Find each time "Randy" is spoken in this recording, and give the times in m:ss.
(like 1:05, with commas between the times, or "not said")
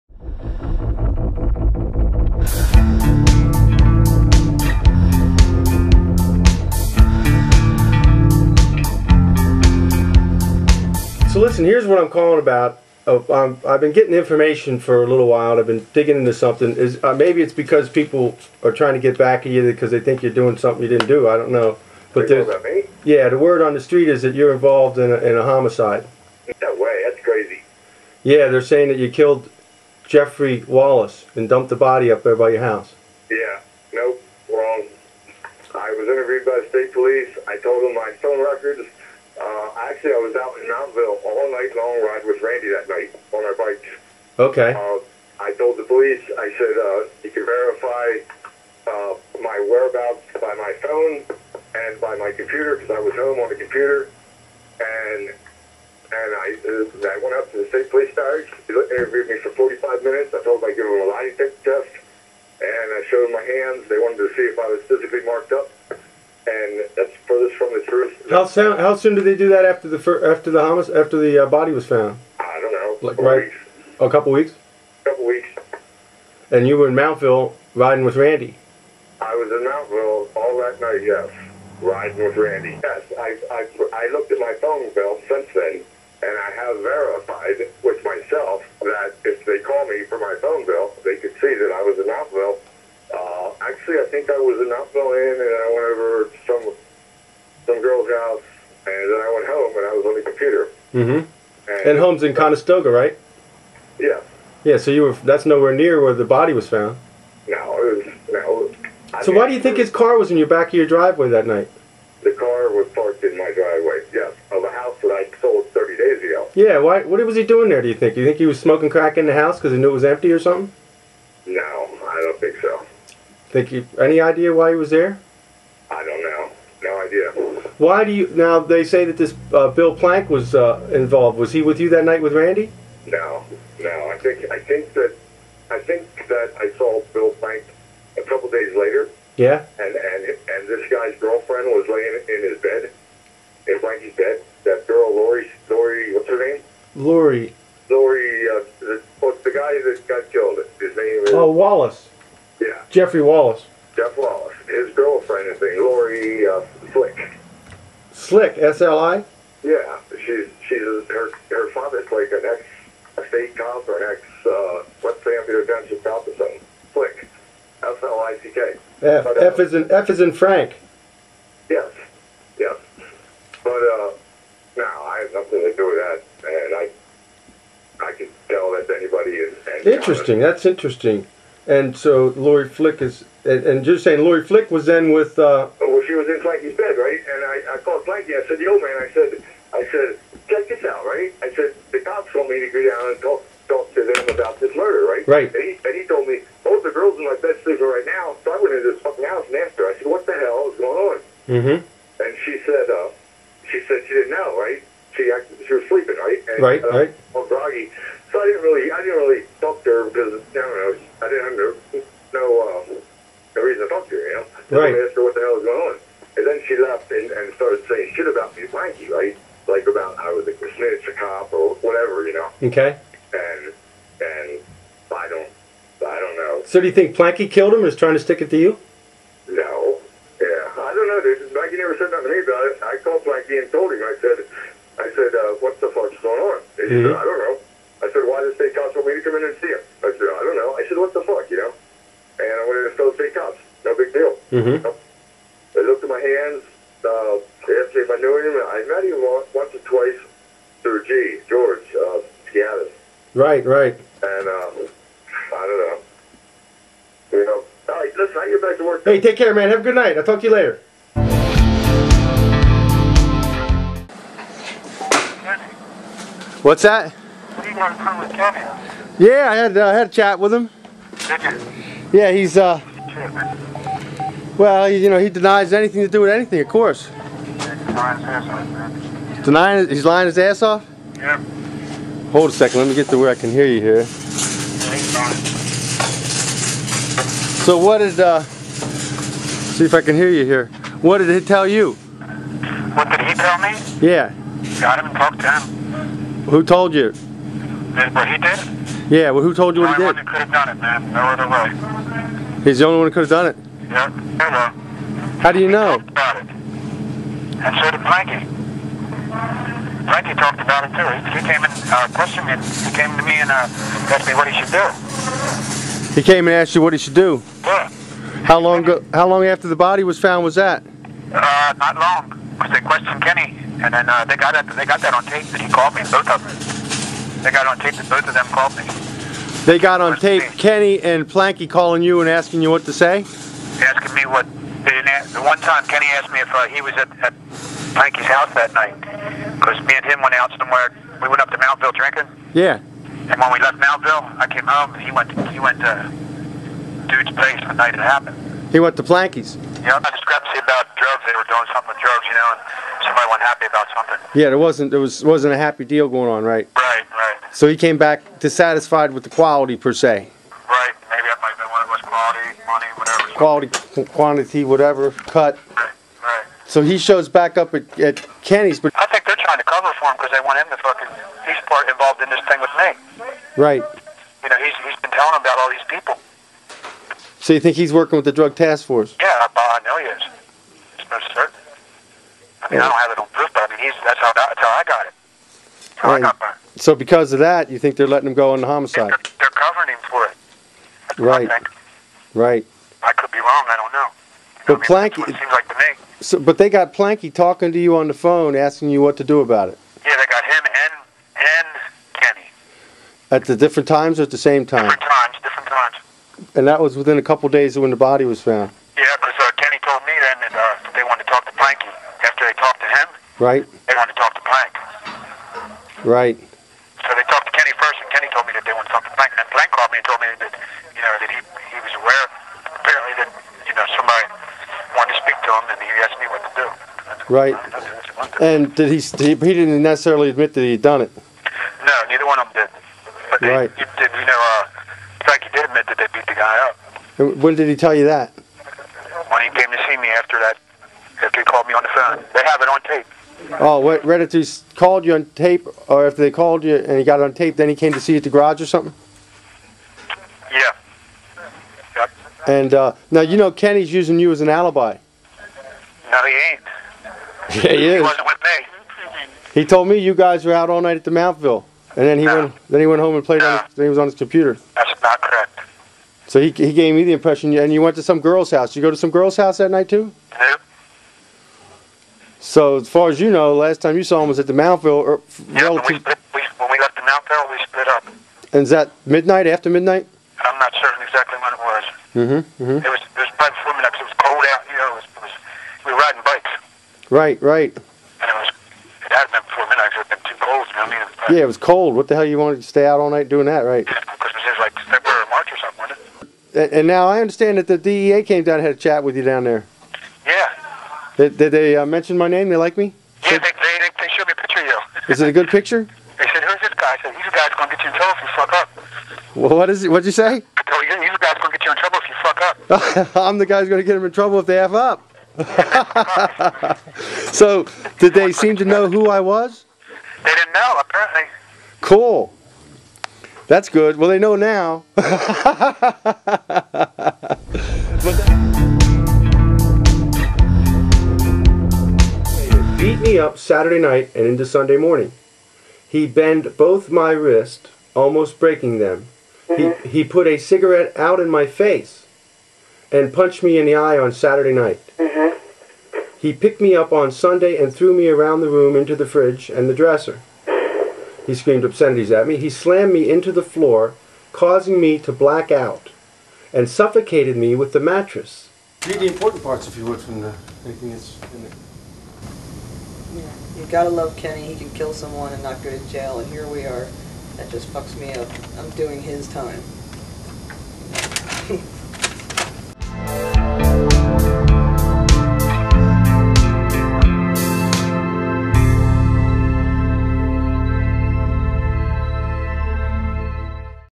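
0:42, 1:18, 1:22, 2:12.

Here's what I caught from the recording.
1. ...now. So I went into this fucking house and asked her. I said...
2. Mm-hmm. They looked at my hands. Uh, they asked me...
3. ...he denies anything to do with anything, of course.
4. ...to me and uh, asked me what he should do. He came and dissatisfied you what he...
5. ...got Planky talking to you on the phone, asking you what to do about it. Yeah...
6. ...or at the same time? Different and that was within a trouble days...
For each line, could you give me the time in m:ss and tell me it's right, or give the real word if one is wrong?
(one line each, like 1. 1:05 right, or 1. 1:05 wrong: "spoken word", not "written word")
1. 3:18 right
2. 4:04 right
3. 4:35 right
4. 5:13 wrong: "asked", not "dissatisfied"
5. 6:36 right
6. 6:44 wrong: "couple", not "trouble".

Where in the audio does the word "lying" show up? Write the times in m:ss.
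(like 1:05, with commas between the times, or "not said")
4:40.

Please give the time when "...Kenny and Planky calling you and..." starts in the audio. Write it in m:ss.
5:30.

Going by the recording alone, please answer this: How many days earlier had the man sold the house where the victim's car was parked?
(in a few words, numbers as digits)
30.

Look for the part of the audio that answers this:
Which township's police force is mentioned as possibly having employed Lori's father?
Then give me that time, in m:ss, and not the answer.
2:45.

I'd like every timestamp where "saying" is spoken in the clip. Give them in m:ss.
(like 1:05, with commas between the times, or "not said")
0:28, 3:04, 3:37.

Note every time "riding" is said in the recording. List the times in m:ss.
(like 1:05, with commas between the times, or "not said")
1:17, 1:21, 8:05.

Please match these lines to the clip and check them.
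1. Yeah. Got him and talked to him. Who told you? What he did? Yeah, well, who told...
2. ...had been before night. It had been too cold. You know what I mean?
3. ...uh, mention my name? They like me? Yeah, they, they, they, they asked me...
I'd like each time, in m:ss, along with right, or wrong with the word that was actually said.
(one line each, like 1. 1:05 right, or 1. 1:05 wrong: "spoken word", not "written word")
1. 4:54 right
2. 8:09 wrong: "midnight", not "night"
3. 8:21 wrong: "showed", not "asked".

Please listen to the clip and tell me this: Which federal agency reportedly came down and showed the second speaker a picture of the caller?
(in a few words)
DEA.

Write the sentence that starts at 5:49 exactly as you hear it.
Yeah, you know, discrepancy about drugs.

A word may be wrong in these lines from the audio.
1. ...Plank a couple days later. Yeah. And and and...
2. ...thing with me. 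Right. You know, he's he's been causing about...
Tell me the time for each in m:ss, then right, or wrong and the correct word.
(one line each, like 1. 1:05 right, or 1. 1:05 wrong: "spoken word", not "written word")
1. 2:17 right
2. 6:12 wrong: "telling", not "causing".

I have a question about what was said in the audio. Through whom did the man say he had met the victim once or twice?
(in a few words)
George.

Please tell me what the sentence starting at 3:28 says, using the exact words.
So I didn't really, I didn't really Right.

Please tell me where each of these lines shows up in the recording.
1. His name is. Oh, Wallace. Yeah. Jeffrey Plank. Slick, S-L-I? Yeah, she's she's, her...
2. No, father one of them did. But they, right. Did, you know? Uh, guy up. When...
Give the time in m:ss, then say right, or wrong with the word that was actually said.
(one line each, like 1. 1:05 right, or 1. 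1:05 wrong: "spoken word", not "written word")
1. 2:30 wrong: "Wallace", not "Plank"
2. 7:11 wrong: "neither", not "father".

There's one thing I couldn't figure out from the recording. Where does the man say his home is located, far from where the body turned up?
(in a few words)
Conestoga.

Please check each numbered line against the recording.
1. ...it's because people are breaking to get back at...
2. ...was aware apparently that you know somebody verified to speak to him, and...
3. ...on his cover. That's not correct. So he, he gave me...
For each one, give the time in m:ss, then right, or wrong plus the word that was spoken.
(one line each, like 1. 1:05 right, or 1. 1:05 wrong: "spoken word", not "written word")
1. 0:17 wrong: "trying", not "breaking"
2. 7:01 wrong: "wanted", not "verified"
3. 7:43 wrong: "computer", not "cover".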